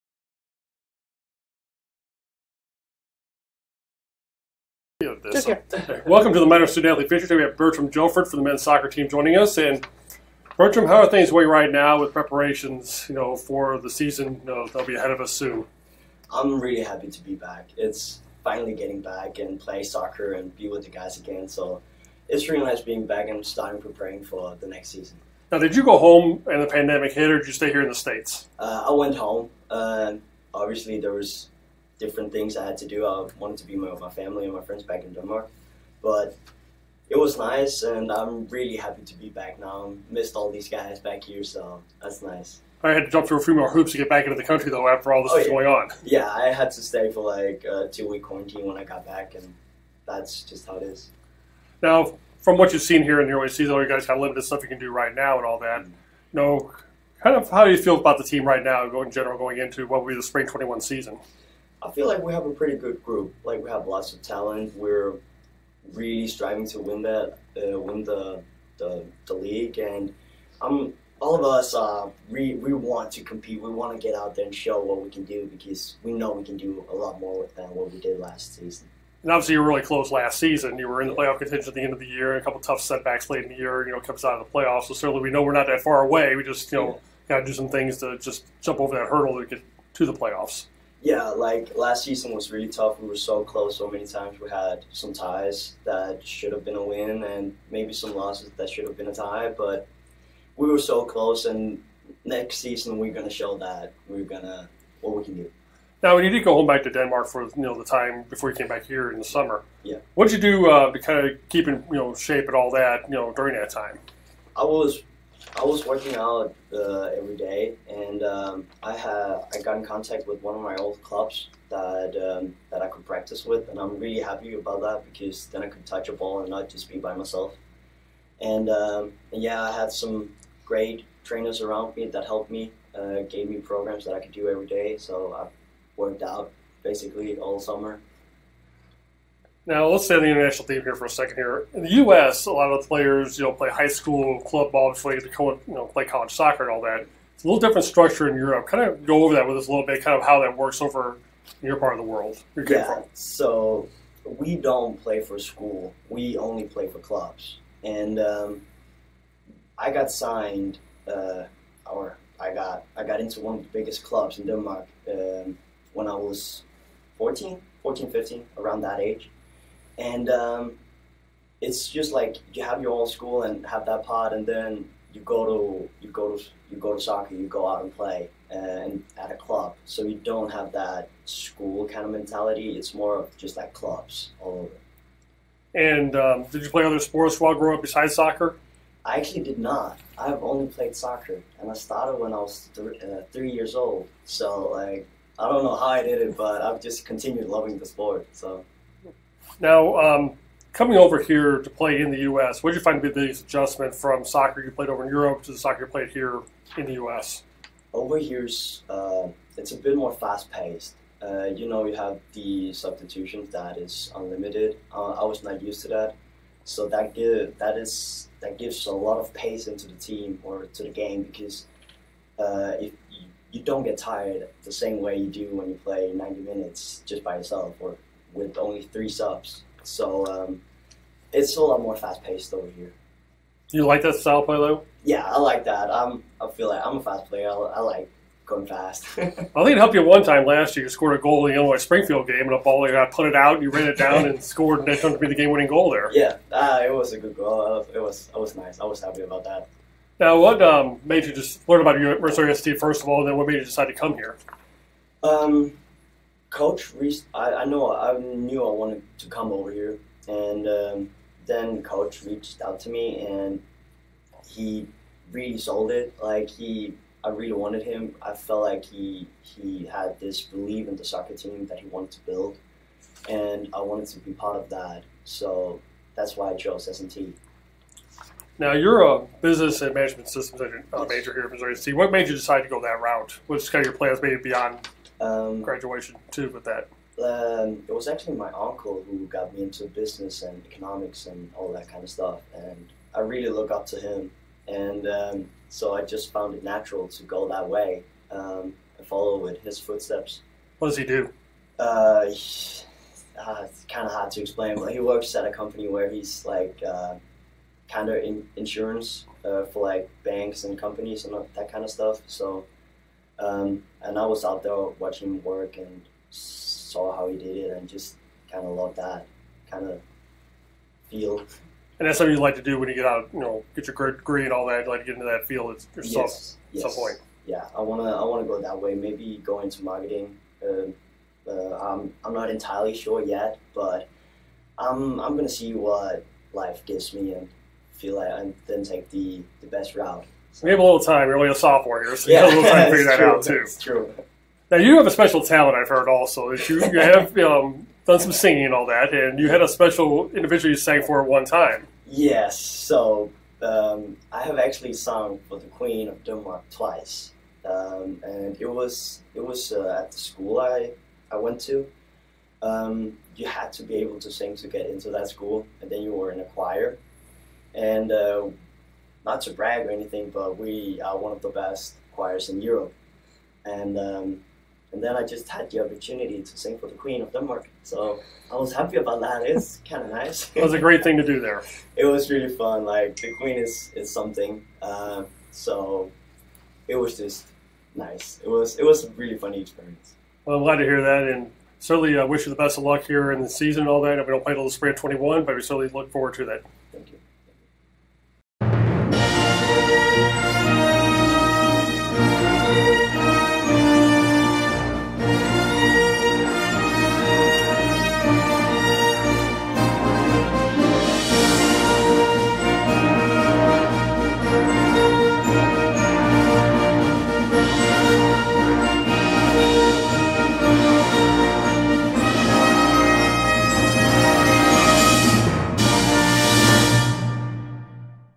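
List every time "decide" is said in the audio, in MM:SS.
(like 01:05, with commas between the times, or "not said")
04:13, 04:42.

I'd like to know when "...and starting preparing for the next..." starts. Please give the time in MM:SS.
00:23.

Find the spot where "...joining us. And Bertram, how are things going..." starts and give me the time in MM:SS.
00:09.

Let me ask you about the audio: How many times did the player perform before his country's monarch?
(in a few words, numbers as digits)
2.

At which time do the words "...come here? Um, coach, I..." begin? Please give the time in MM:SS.
04:13.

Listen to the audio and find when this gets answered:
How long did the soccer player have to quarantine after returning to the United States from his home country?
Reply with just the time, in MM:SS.
00:47.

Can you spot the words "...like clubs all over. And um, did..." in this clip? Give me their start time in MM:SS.
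03:03.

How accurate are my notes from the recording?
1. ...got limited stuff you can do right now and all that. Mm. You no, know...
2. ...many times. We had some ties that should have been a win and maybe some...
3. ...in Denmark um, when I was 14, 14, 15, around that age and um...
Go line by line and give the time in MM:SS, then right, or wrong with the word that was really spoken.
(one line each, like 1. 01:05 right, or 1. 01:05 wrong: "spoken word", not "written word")
1. 00:54 right
2. 01:33 right
3. 02:44 right.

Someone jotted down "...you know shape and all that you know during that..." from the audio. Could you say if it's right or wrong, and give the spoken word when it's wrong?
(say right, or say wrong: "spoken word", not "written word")
right.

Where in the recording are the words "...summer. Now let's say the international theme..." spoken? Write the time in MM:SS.
02:17.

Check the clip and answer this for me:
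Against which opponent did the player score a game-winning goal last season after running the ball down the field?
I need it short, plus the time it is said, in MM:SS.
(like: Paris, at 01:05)
Illinois Springfield, at 04:01.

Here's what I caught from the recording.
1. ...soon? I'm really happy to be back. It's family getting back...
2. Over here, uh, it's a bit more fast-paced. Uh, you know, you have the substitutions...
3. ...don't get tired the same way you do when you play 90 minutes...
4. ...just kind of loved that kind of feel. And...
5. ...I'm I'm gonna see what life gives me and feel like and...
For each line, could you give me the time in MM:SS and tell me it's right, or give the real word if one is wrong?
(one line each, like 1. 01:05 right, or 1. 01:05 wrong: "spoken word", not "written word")
1. 00:15 wrong: "finally", not "family"
2. 03:27 right
3. 03:43 right
4. 05:17 right
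5. 05:34 right.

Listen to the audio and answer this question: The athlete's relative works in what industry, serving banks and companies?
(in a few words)
Insurance.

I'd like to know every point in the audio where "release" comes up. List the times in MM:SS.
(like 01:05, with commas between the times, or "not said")
not said.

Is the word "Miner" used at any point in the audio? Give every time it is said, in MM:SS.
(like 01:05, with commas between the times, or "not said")
00:06.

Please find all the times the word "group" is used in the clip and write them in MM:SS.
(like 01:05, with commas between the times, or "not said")
01:03.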